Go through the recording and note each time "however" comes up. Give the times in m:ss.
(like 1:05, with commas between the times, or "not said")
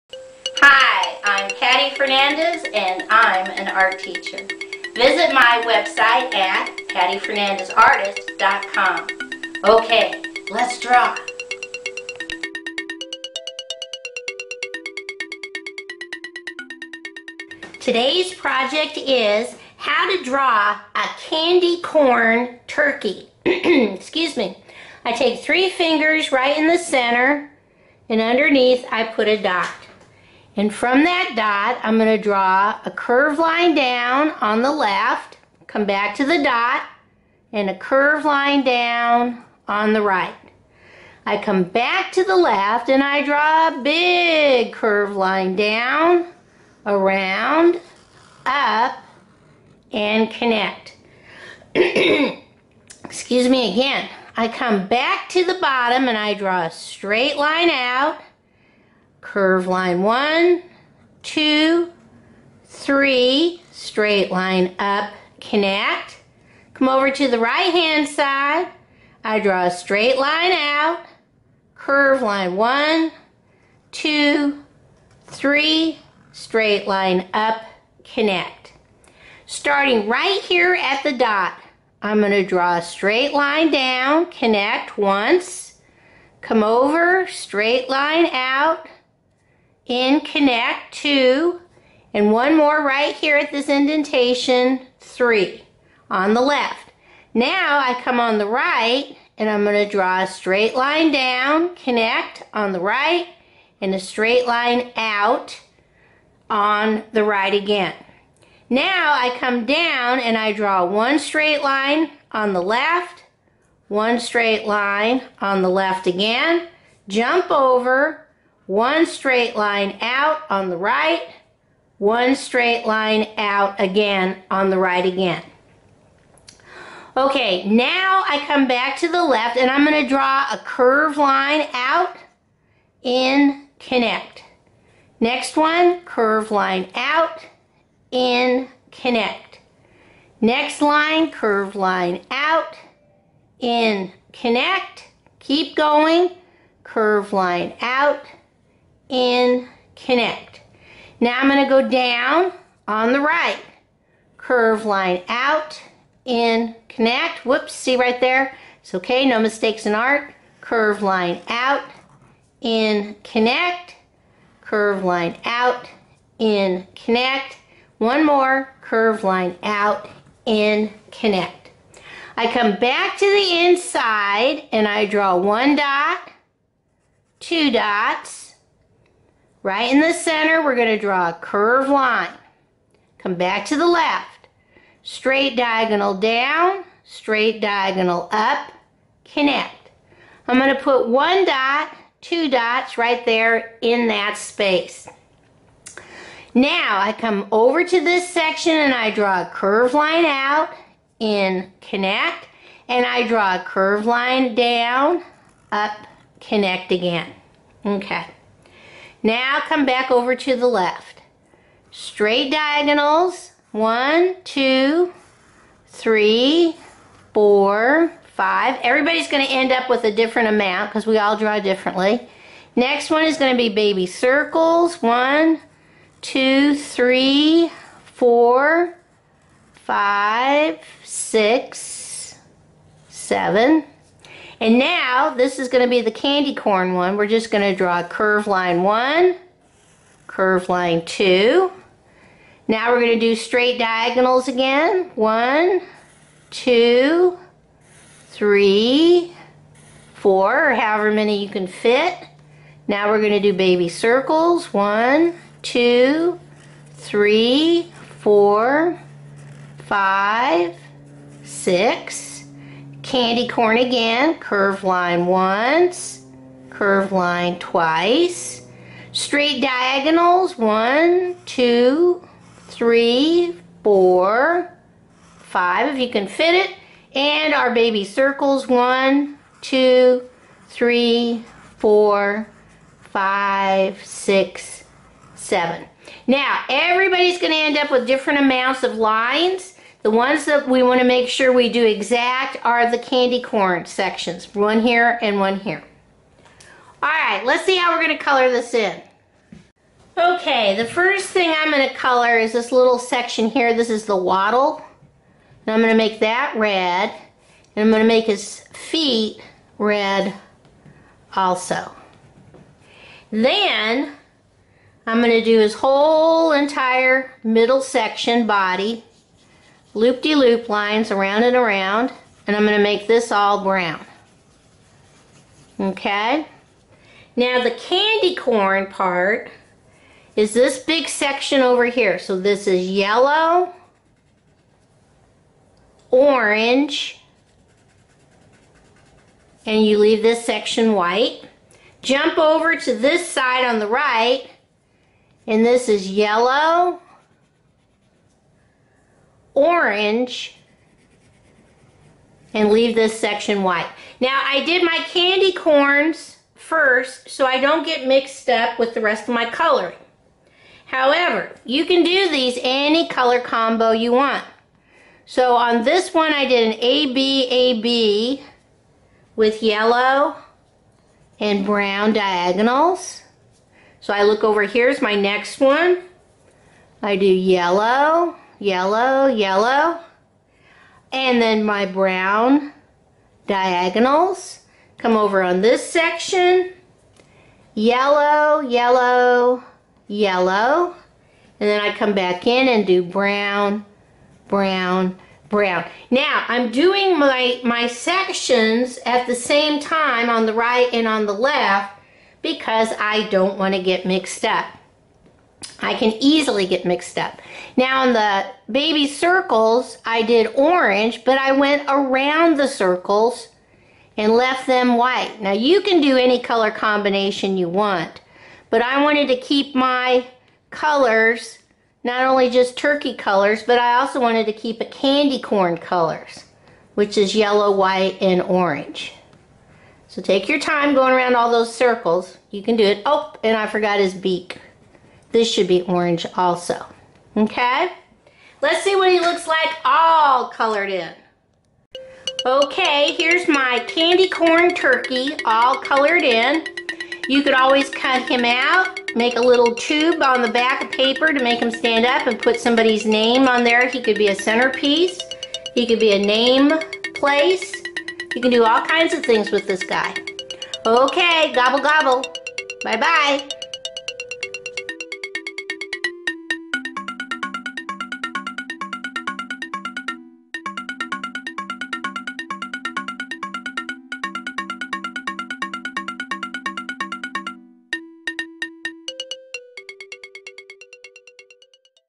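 4:10, 6:00.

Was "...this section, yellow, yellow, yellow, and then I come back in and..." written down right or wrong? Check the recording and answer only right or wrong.
right.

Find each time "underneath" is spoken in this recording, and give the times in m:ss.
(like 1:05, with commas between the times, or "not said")
0:28.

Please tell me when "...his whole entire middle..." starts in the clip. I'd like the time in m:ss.
5:15.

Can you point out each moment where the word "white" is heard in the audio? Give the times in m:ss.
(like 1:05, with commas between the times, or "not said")
5:40, 5:53, 6:54, 7:07.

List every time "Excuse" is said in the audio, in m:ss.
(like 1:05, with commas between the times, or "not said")
0:23, 0:51.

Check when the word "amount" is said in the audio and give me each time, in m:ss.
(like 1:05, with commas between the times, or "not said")
3:40, 4:48.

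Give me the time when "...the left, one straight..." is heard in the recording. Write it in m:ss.
1:52.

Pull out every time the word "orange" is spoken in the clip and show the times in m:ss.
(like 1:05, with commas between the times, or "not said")
5:36, 5:49, 6:50, 7:08, 7:15.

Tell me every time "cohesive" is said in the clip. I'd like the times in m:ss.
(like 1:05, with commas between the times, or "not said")
not said.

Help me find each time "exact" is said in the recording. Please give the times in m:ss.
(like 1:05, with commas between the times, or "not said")
4:51.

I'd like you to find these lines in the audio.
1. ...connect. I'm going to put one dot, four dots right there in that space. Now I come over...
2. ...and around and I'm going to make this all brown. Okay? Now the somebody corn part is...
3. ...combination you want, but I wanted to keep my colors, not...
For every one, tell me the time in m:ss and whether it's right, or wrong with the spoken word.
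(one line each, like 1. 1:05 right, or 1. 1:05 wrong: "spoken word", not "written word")
1. 3:09 wrong: "two", not "four"
2. 5:21 wrong: "candy", not "somebody"
3. 6:56 right.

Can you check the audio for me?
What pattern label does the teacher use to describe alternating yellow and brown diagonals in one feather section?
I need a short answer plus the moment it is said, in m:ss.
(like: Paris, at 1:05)
AB AB, at 6:06.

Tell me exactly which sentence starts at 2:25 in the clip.
Keep going, curve line out in, connect.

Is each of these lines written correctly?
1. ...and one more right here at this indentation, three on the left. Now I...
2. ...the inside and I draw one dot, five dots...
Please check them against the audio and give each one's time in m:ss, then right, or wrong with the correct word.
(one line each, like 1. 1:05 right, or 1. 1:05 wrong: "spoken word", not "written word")
1. 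1:32 right
2. 2:53 wrong: "two", not "five".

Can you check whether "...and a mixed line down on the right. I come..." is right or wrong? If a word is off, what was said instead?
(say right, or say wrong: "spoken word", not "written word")
wrong: "curved", not "mixed".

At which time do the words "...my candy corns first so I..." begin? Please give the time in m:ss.
5:54.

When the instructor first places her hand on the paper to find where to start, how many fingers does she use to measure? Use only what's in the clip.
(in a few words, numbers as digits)
3.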